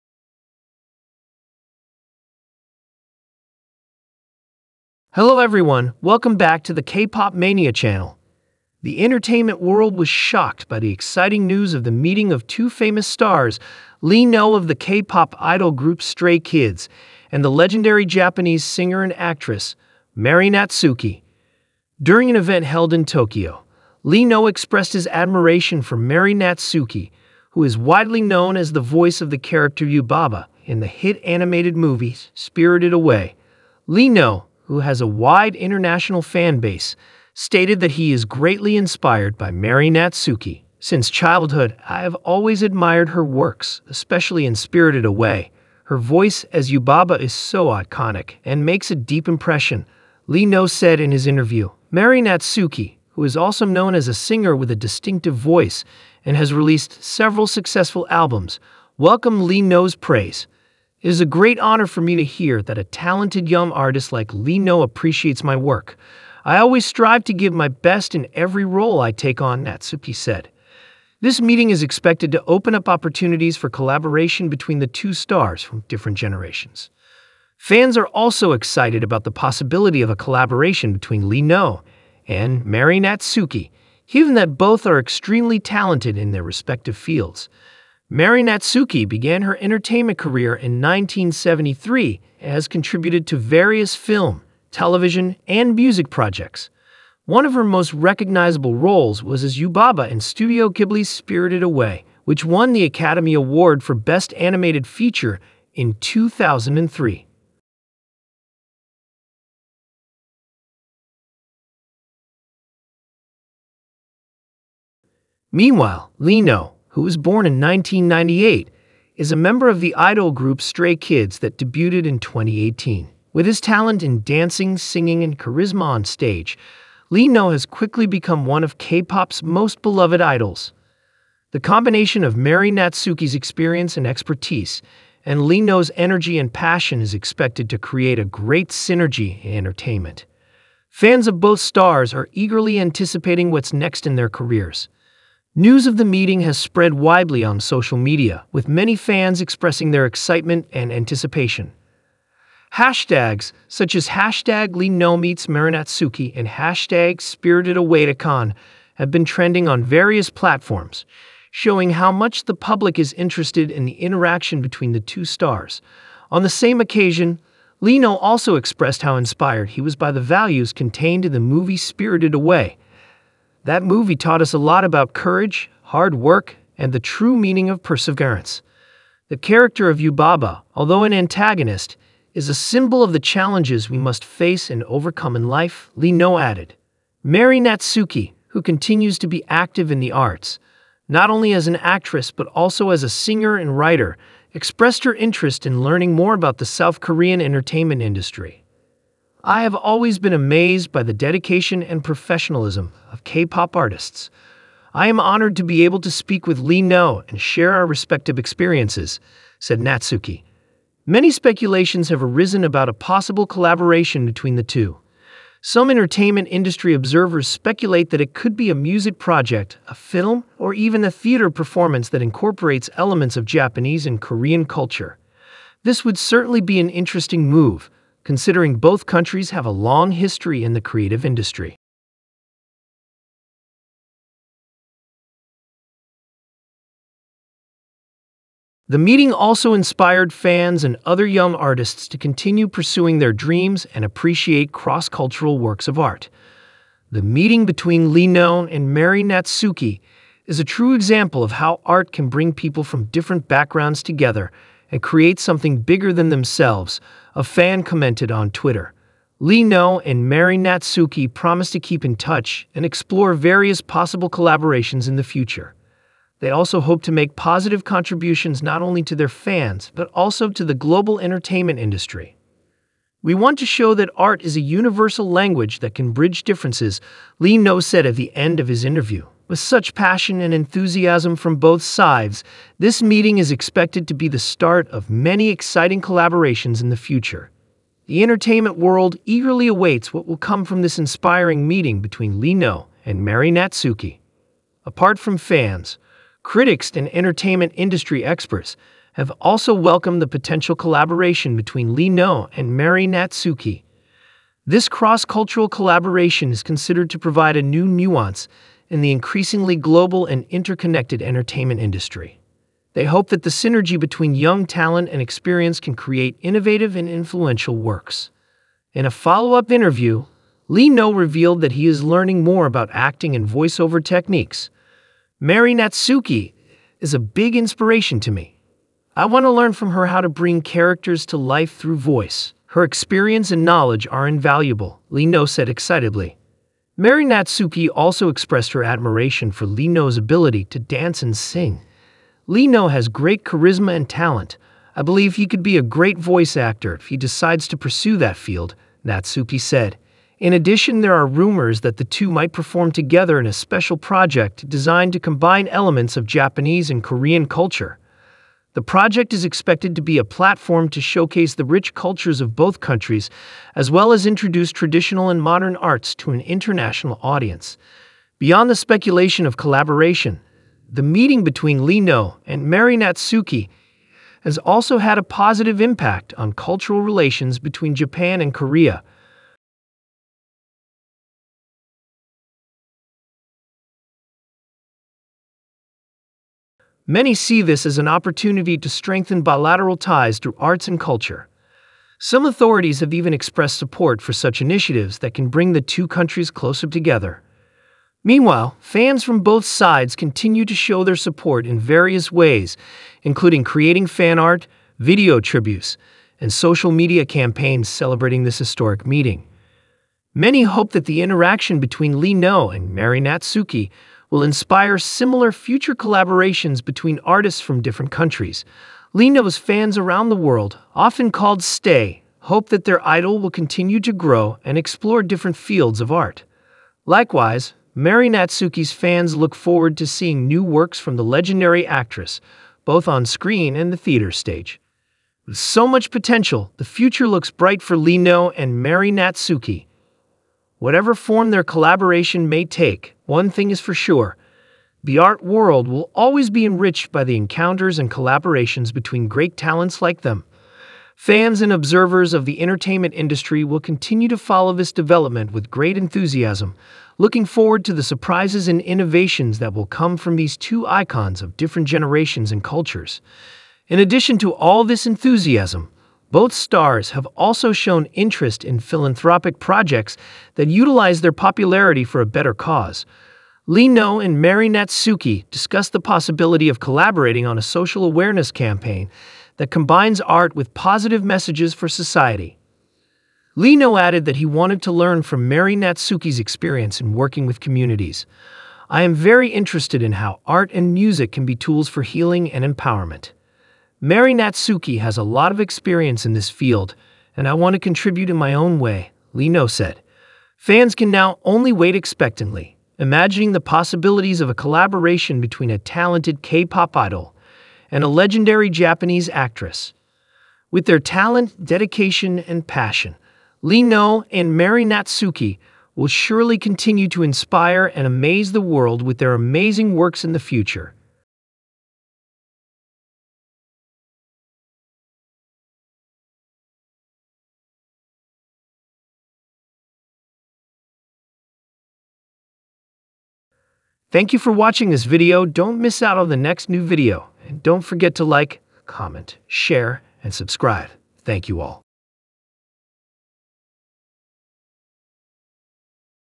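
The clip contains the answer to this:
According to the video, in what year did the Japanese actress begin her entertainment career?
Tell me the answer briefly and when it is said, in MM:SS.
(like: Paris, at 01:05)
1973, at 01:30.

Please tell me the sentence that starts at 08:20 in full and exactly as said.
Fans can now only wait expectantly, imagining the possibilities of a collaboration between a talented K-pop idol and a legendary Japanese actress.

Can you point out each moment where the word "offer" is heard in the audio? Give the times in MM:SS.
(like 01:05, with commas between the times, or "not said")
not said.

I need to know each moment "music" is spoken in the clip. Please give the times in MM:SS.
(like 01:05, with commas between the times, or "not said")
01:35, 03:38, 08:10.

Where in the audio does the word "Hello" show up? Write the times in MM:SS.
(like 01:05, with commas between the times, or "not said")
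00:05.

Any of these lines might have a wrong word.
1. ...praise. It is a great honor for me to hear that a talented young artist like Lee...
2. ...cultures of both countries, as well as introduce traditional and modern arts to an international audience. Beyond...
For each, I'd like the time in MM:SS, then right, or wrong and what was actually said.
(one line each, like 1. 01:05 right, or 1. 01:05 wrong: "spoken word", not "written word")
1. 00:59 right
2. 06:01 right.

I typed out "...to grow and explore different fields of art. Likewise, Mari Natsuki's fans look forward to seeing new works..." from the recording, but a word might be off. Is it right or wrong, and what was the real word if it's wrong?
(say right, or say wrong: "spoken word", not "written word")
right.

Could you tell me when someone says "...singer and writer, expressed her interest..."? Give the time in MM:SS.
03:13.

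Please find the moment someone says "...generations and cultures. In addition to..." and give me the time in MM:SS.
07:41.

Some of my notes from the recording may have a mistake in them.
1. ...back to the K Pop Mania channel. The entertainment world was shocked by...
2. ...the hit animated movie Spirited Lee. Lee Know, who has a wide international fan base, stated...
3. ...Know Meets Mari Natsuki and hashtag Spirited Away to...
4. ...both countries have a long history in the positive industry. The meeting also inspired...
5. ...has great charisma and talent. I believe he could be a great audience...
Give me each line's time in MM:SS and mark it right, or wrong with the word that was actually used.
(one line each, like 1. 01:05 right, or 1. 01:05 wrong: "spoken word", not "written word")
1. 00:06 right
2. 00:30 wrong: "Away", not "Lee"
3. 02:34 right
4. 03:48 wrong: "creative", not "positive"
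5. 05:42 wrong: "voice", not "audience".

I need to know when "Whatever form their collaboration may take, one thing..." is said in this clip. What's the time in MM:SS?
07:20.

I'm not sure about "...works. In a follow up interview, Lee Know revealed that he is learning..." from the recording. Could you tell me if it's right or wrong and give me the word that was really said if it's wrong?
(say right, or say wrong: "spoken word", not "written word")
right.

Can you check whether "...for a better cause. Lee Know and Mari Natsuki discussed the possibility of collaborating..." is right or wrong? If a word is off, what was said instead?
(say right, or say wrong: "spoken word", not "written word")
right.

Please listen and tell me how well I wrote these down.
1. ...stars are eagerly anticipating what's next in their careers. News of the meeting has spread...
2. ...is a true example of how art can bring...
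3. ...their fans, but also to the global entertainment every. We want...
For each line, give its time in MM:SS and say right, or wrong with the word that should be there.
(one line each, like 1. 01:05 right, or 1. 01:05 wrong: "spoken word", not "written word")
1. 02:21 right
2. 04:10 right
3. 04:29 wrong: "industry", not "every".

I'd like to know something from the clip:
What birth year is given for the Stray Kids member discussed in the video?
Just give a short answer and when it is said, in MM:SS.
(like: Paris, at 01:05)
1998, at 01:57.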